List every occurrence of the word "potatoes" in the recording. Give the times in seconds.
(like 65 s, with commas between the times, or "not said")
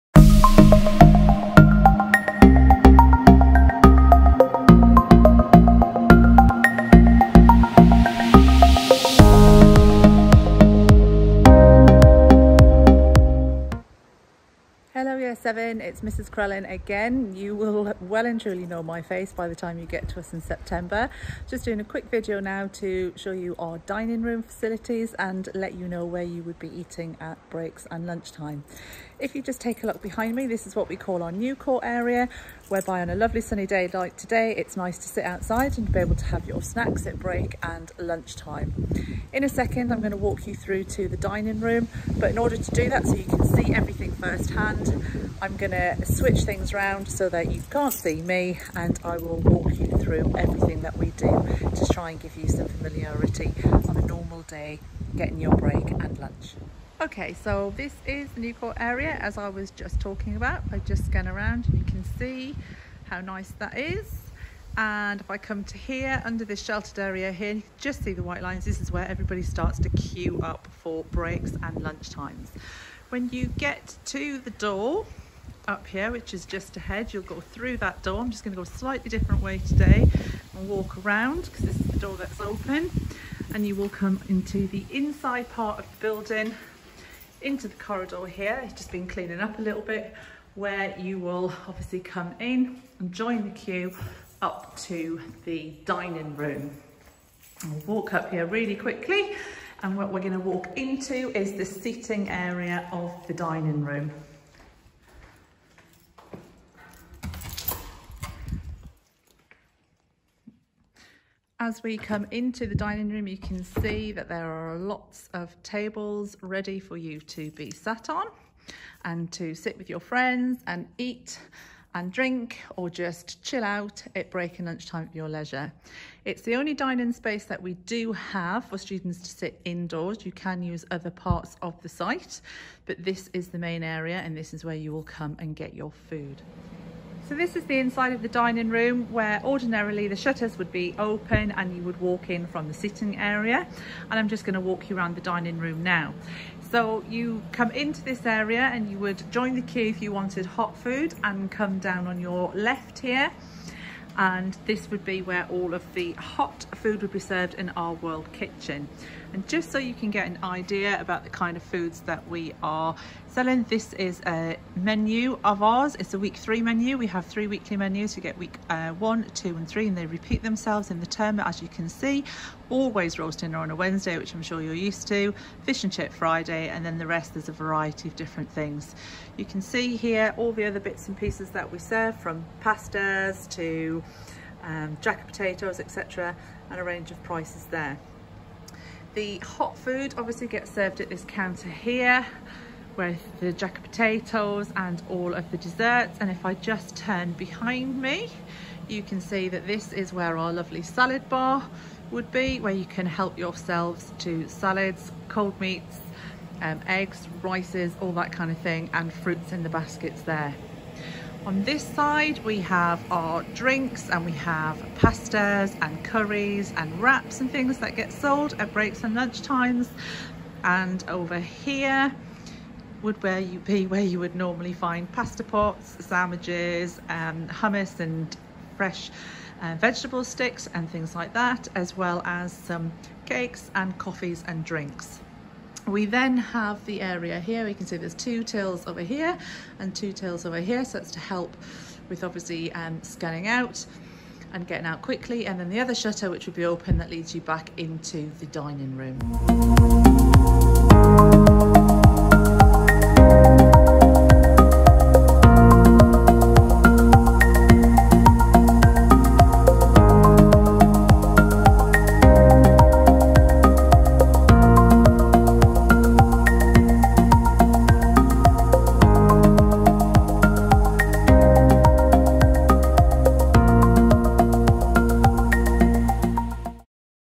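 185 s, 193 s.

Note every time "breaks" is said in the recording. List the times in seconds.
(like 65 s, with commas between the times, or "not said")
27 s, 37 s, 55 s, 71 s, 124 s, 218 s.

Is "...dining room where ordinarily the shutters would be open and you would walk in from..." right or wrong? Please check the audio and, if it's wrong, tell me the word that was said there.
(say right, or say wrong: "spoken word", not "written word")
right.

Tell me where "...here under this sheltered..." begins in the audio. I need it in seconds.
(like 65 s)
65 s.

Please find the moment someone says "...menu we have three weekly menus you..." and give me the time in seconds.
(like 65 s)
166 s.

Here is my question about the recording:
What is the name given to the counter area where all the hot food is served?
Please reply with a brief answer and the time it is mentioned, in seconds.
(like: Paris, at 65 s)
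world kitchen, at 157 s.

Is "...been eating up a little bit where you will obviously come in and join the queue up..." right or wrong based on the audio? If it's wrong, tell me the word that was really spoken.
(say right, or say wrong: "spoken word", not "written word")
wrong: "cleaning", not "eating".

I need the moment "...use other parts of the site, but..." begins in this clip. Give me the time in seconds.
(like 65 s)
130 s.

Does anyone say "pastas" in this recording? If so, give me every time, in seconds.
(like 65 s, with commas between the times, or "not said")
182 s, 214 s, 225 s.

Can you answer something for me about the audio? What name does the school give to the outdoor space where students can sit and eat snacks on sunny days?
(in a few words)
new court area.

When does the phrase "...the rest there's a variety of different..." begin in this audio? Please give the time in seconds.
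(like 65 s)
176 s.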